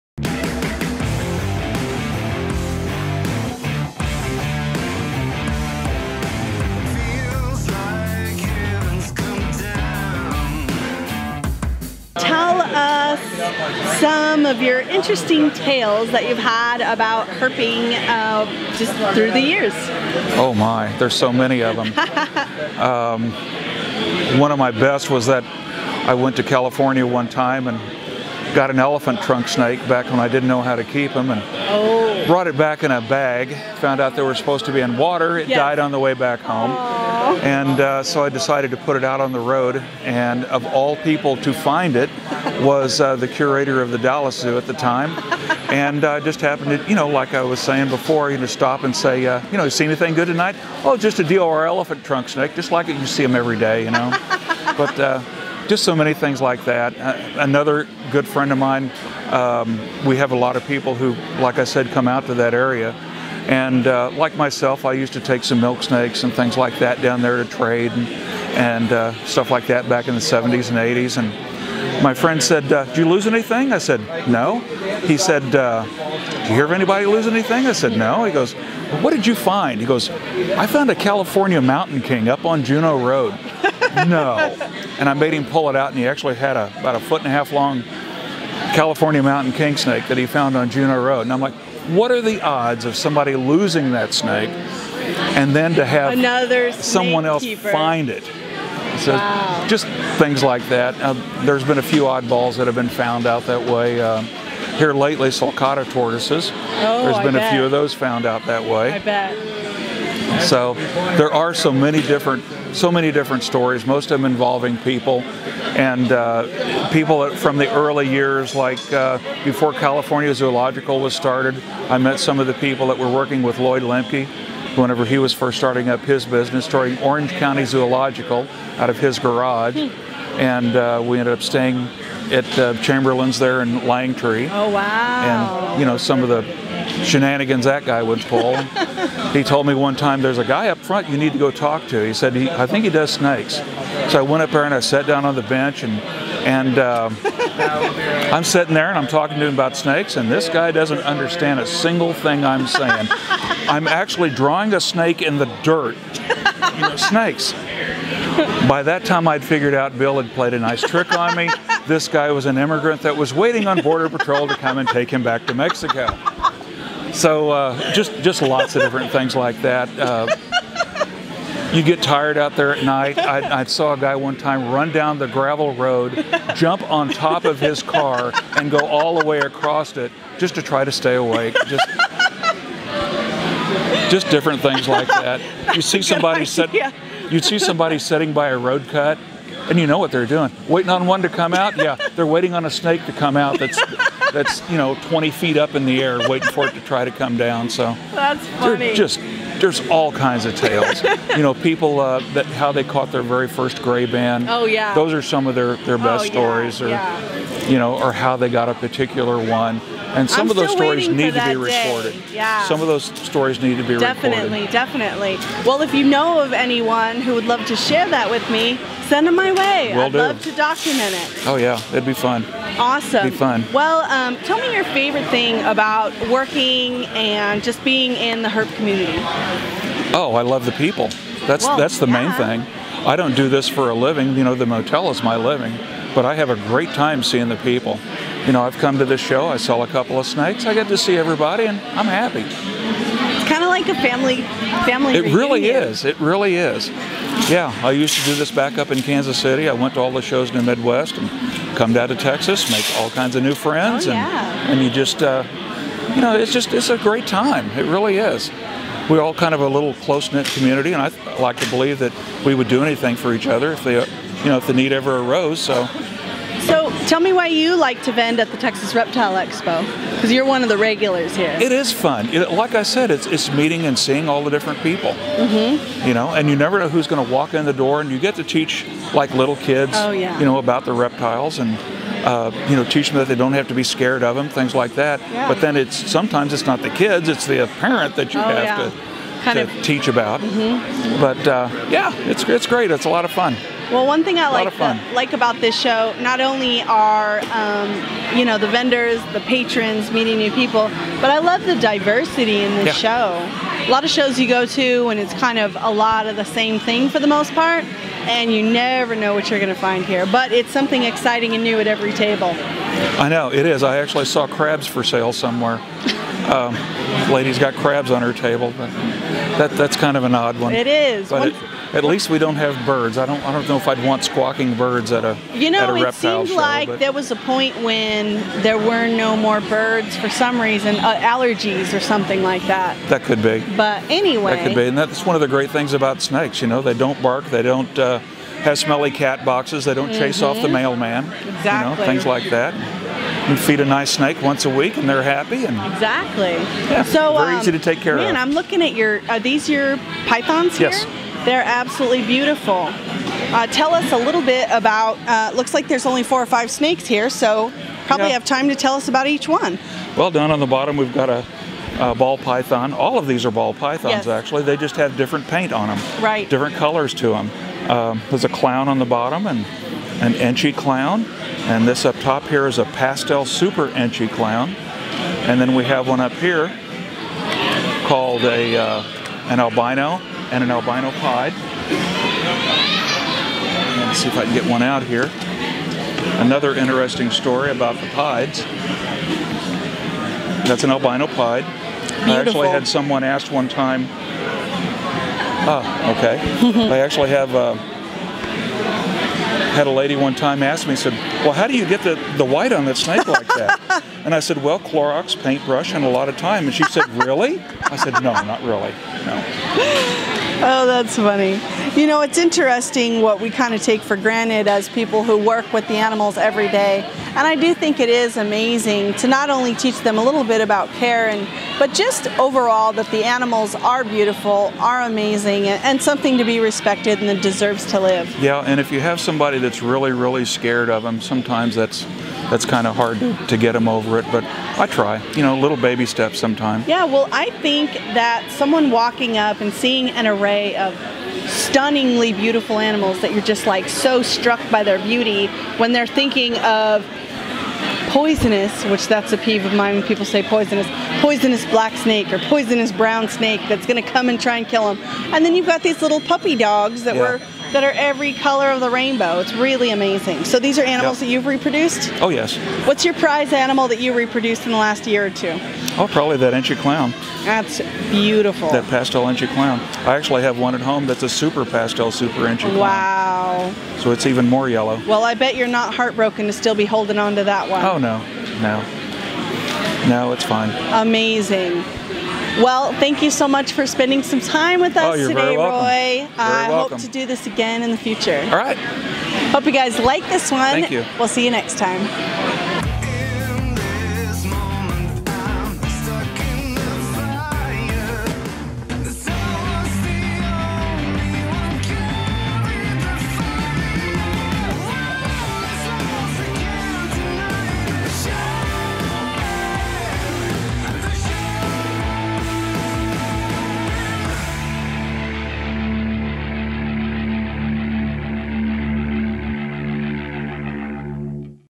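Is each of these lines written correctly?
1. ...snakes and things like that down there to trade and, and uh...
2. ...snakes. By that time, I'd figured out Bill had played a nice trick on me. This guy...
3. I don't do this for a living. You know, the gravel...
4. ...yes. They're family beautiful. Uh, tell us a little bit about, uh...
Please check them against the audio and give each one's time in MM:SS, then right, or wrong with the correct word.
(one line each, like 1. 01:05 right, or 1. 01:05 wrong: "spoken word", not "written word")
1. 01:05 right
2. 02:36 right
3. 03:53 wrong: "motel", not "gravel"
4. 05:50 wrong: "absolutely", not "family".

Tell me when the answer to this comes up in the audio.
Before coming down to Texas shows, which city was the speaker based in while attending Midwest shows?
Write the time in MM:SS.
04:09.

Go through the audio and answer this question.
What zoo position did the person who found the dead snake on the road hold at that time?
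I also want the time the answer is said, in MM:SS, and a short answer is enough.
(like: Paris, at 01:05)
Curator of the Dallas Zoo, at 00:43.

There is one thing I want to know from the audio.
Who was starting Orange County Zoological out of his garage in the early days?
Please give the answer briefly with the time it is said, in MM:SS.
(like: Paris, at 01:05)
Lloyd Lemke, at 02:03.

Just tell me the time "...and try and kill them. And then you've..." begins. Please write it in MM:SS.
07:34.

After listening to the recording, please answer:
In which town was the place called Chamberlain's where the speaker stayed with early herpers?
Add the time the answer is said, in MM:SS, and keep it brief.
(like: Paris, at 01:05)
Langtry, at 02:13.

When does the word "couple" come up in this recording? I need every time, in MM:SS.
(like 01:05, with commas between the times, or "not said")
03:59.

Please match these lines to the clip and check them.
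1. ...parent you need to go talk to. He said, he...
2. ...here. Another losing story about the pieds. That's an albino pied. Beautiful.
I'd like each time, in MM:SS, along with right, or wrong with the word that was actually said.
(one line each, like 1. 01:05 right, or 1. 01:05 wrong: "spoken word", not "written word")
1. 02:20 wrong: "front", not "parent"
2. 06:25 wrong: "interesting", not "losing".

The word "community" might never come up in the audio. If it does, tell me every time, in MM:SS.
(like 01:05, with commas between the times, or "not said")
03:48, 04:20.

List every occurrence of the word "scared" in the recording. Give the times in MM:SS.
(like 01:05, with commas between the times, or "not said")
04:43, 07:10.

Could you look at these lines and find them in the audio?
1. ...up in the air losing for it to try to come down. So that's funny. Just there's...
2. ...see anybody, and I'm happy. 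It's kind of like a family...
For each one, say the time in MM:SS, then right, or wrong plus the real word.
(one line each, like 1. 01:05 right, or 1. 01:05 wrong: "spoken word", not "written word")
1. 03:15 wrong: "waiting", not "losing"
2. 04:00 wrong: "everybody", not "anybody".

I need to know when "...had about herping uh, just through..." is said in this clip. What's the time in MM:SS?
00:16.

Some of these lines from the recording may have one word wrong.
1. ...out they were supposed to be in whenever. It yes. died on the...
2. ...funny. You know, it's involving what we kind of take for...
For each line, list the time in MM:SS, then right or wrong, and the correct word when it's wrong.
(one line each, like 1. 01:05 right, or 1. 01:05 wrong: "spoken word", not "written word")
1. 00:34 wrong: "water", not "whenever"
2. 06:51 wrong: "interesting", not "involving".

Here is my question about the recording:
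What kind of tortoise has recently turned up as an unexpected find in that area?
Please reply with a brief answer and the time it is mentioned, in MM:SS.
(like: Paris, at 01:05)
Sulcata, at 01:45.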